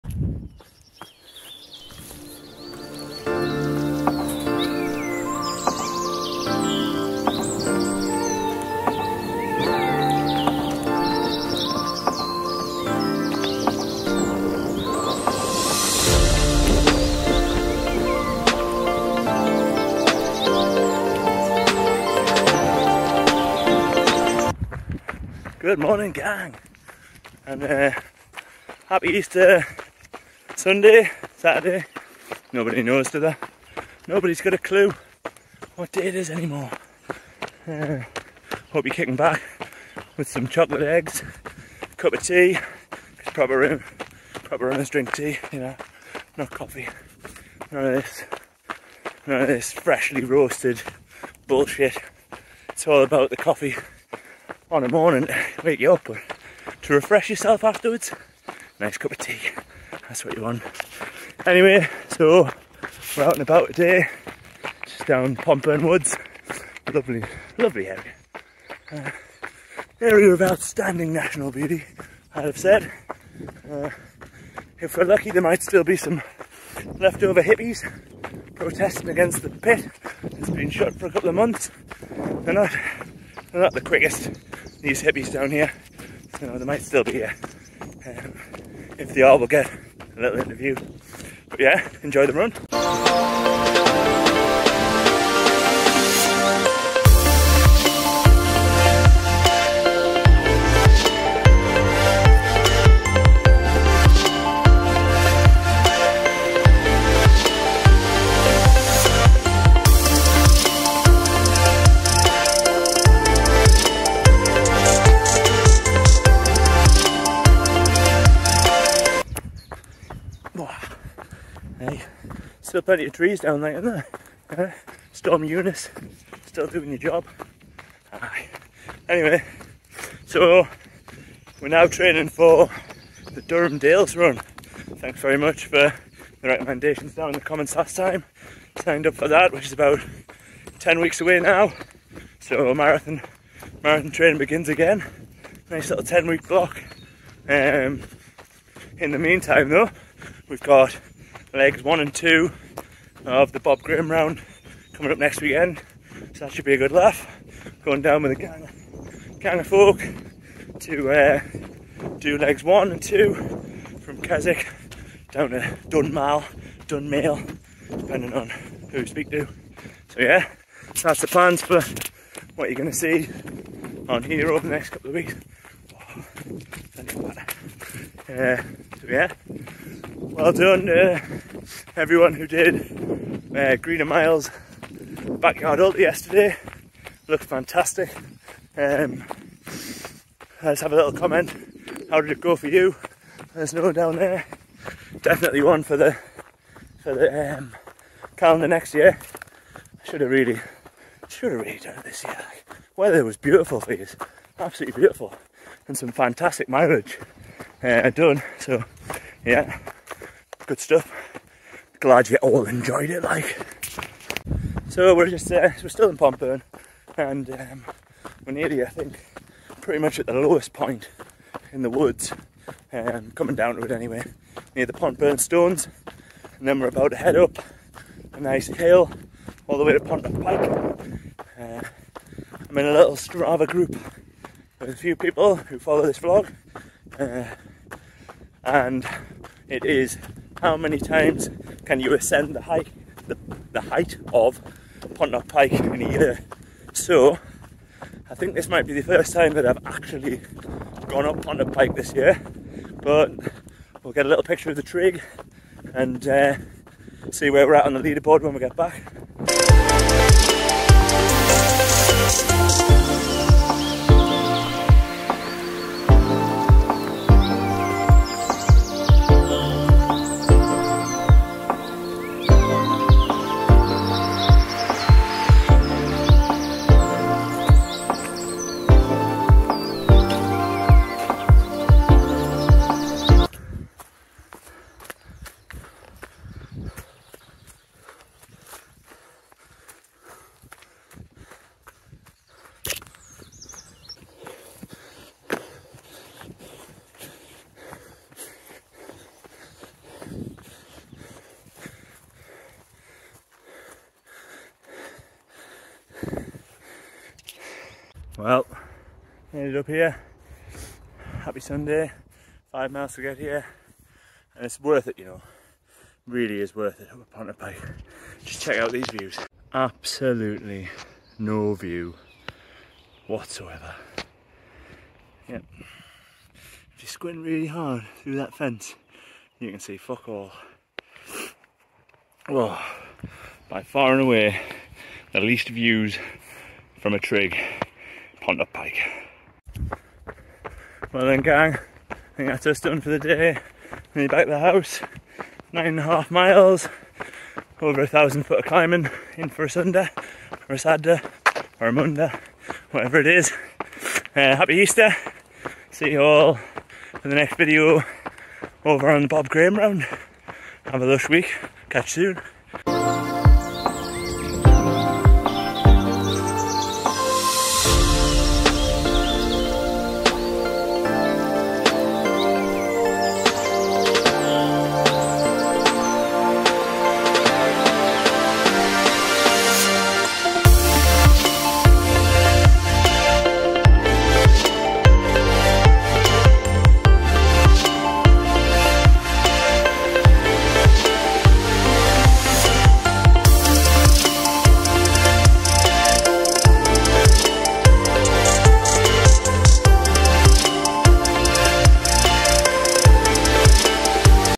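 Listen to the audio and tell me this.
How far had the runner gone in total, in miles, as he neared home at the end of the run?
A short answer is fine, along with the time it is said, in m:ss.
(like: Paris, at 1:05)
9.5 miles, at 5:45.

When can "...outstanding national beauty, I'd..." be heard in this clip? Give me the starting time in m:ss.
1:10.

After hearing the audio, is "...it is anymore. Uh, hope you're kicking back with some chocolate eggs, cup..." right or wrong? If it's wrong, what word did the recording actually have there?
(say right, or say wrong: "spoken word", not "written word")
right.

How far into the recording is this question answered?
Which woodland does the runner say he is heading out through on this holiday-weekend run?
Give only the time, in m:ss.
1:05.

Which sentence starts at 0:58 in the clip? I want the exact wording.
Nice cup of tea, that's what you want.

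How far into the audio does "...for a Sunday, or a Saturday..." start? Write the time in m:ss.
5:49.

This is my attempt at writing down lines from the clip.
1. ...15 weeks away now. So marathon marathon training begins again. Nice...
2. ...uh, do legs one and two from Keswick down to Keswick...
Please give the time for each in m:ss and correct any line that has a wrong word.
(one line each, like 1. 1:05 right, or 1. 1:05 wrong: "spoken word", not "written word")
1. 2:20 wrong: "10", not "15"
2. 2:41 wrong: "Dunmail", not "Keswick".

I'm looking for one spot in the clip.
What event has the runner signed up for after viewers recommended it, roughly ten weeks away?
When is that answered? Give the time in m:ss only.
2:13.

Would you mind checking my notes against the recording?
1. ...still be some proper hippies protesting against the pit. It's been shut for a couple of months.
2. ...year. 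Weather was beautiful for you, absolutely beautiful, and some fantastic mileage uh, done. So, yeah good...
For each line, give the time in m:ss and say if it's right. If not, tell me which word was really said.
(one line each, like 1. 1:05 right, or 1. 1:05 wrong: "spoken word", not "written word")
1. 1:15 wrong: "leftover", not "proper"
2. 3:22 right.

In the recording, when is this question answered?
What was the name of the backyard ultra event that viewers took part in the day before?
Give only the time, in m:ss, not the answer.
3:03.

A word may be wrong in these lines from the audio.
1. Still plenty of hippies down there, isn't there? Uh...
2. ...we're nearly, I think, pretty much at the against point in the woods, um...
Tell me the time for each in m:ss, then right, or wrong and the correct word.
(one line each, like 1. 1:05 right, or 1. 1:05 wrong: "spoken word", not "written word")
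1. 2:02 wrong: "trees", not "hippies"
2. 3:38 wrong: "lowest", not "against".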